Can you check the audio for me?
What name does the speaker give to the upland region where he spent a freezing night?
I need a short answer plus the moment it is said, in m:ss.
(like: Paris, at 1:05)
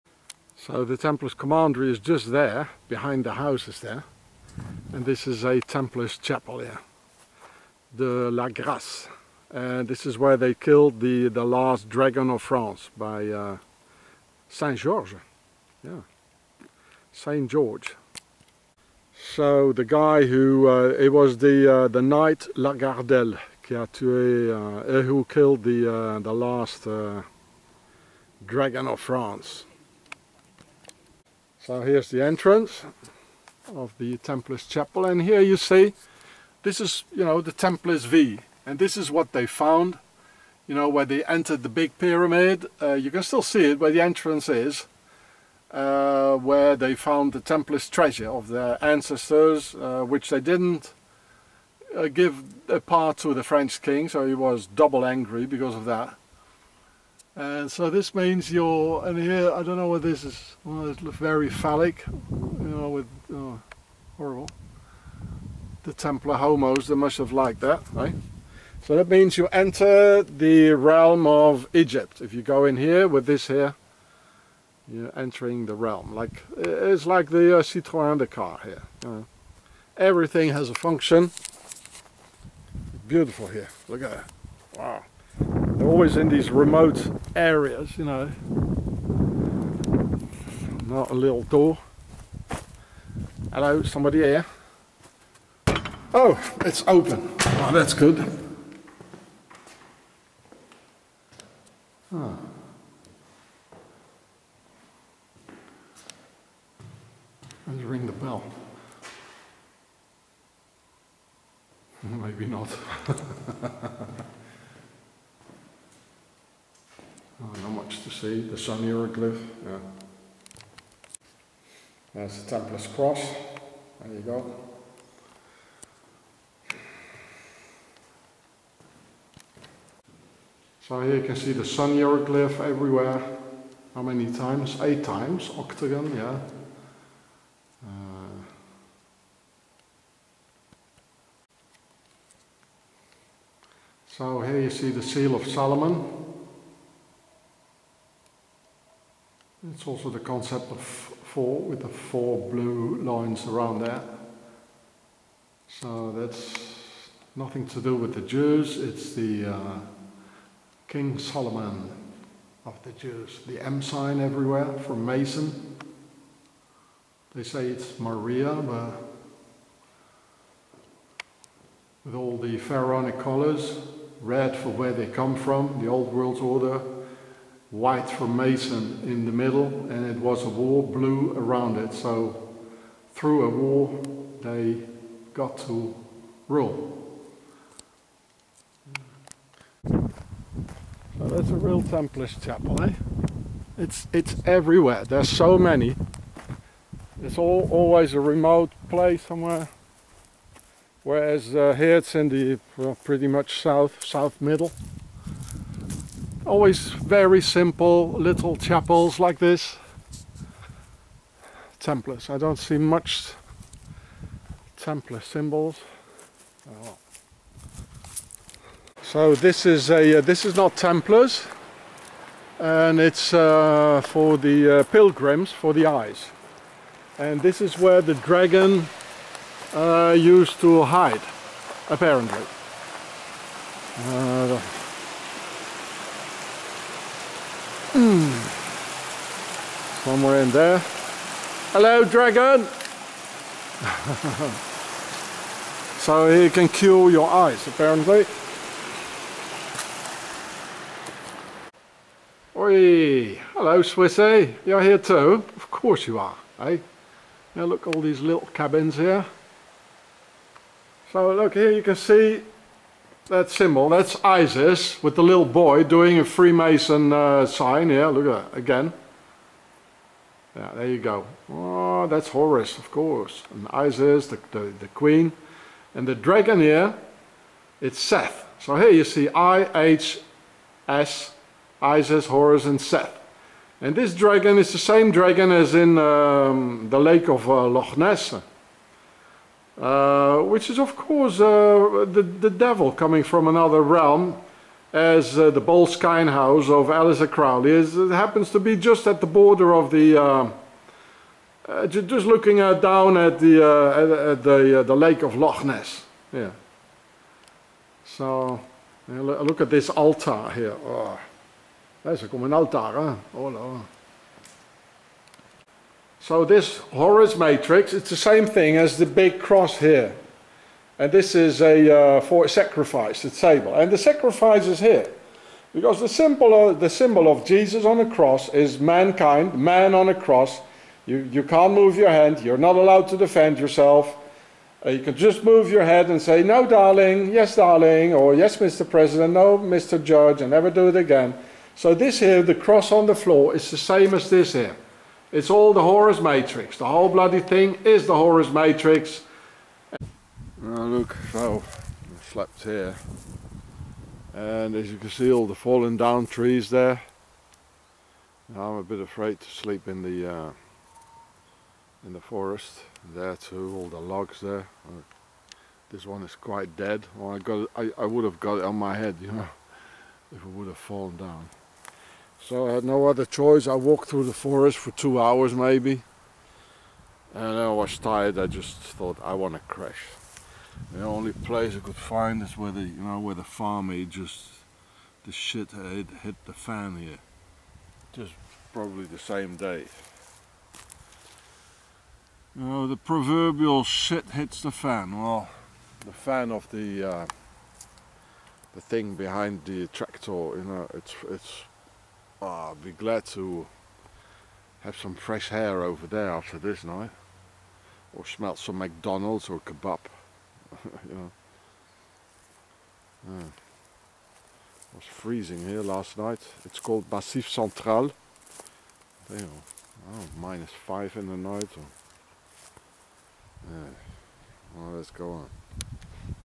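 Massif Central, at 6:57.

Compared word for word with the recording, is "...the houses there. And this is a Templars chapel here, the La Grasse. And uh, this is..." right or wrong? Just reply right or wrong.
right.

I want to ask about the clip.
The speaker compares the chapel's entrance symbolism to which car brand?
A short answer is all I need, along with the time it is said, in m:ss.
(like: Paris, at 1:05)
Citroën, at 1:17.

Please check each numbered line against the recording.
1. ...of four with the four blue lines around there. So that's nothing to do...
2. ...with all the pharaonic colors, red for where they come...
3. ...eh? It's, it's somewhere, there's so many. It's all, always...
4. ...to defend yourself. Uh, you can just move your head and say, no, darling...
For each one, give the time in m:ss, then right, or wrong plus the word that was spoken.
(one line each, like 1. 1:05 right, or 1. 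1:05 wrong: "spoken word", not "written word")
1. 2:30 right
2. 2:52 right
3. 3:12 wrong: "everywhere", not "somewhere"
4. 5:33 right.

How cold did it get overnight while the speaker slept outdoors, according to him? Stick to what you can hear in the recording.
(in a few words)
minus 5.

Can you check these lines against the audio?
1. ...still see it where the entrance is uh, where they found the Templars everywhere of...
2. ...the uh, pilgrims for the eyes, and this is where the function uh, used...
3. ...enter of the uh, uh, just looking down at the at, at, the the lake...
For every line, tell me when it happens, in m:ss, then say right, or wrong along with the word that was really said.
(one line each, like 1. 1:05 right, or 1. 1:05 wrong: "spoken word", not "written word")
1. 0:43 wrong: "treasure", not "everywhere"
2. 3:44 wrong: "dragon", not "function"
3. 4:59 wrong: "border", not "enter".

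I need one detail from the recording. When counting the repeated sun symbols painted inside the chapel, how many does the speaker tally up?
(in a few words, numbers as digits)
8.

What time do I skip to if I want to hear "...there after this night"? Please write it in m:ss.
6:46.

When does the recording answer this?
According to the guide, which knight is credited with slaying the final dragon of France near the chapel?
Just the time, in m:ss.
0:22.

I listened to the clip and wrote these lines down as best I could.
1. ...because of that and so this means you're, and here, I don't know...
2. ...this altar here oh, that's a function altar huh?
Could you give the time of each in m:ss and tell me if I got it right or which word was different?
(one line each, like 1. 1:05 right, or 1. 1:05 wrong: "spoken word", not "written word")
1. 0:55 right
2. 5:09 wrong: "common", not "function".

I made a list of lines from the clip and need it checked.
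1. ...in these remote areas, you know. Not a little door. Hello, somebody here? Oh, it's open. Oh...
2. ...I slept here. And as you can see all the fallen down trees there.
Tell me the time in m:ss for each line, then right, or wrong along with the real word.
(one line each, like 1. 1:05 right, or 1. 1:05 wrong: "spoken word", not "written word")
1. 1:26 right
2. 5:52 right.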